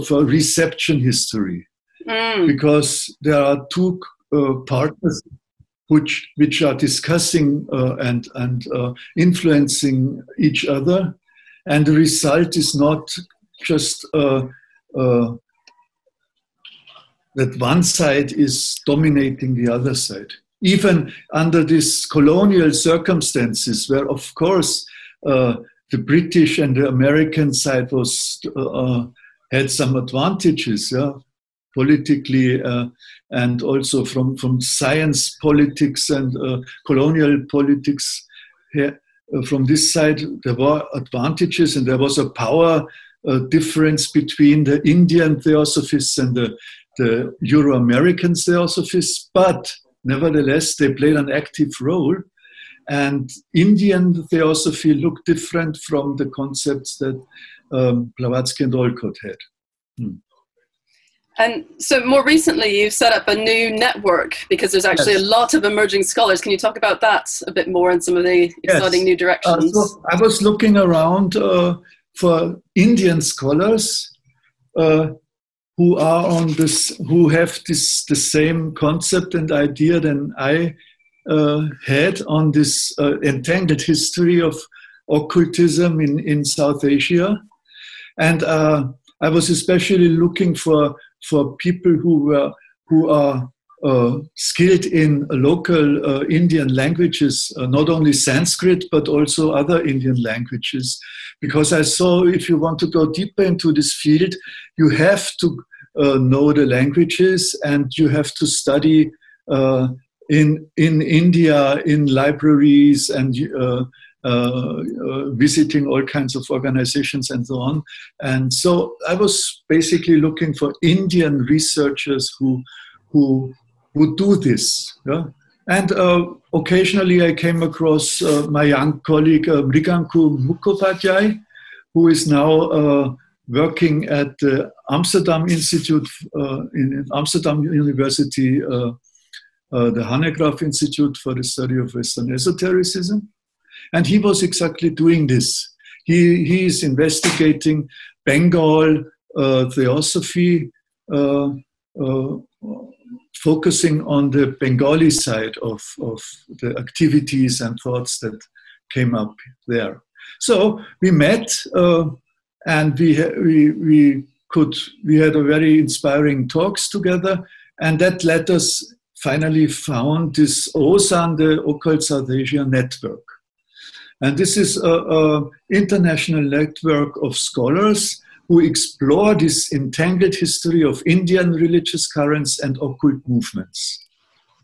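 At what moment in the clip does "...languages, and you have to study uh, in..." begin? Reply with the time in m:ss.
1:46.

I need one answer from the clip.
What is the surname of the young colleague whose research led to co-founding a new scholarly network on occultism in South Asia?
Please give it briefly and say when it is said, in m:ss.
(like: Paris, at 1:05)
Mukhopadhyay, at 2:09.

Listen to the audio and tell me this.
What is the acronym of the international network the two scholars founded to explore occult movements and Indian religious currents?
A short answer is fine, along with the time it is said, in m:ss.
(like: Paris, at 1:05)
OSAN, at 2:50.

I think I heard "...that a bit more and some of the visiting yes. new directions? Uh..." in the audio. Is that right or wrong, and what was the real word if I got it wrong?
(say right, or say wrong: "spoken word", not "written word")
wrong: "exciting", not "visiting".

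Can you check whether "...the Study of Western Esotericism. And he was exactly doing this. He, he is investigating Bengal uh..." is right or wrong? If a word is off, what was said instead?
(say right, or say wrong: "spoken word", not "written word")
right.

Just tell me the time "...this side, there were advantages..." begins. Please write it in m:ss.
0:39.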